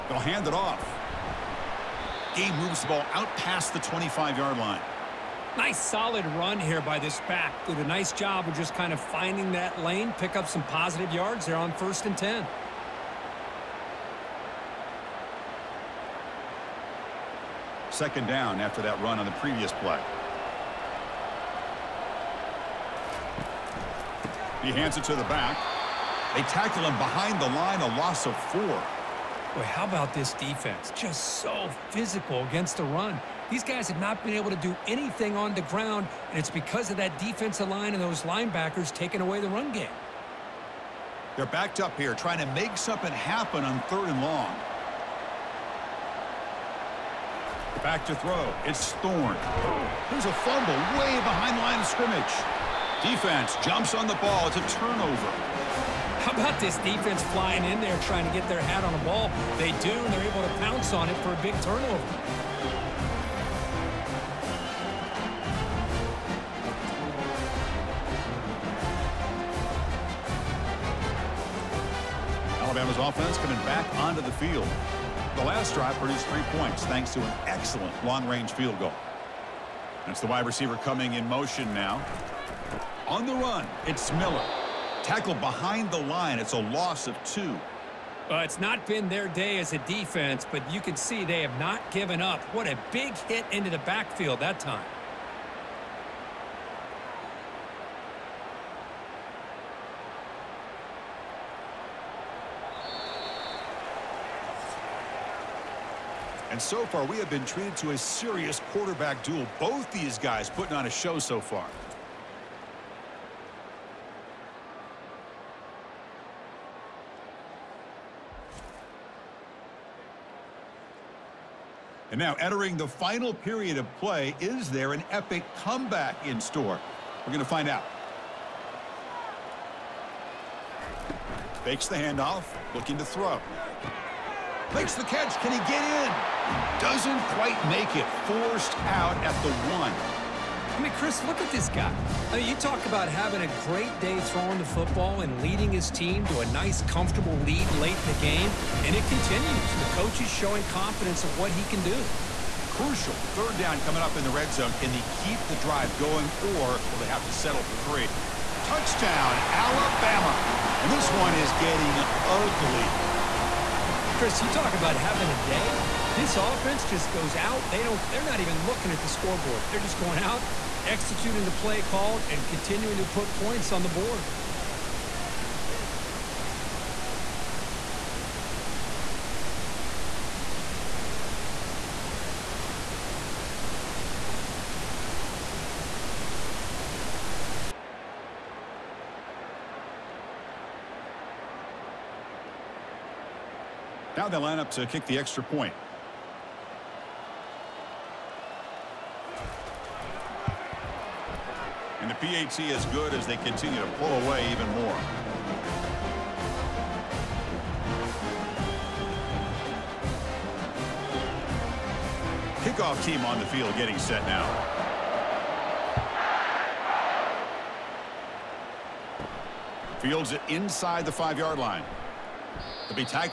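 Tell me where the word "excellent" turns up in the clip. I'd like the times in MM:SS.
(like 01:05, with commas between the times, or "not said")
01:17.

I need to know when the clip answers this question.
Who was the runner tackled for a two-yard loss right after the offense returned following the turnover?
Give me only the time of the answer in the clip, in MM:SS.
01:24.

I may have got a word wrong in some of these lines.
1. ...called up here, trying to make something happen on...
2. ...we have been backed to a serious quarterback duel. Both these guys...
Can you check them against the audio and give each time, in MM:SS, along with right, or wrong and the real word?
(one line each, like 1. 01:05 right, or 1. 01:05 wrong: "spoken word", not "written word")
1. 00:41 wrong: "backed", not "called"
2. 01:47 wrong: "treated", not "backed".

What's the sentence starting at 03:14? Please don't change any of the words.
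Now they line up uh, to kick the extra point.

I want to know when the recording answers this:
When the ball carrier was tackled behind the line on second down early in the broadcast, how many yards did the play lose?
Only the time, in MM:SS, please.
00:27.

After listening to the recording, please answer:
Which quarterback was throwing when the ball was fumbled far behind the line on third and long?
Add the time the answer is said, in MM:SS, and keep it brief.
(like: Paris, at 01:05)
Thorne, at 00:48.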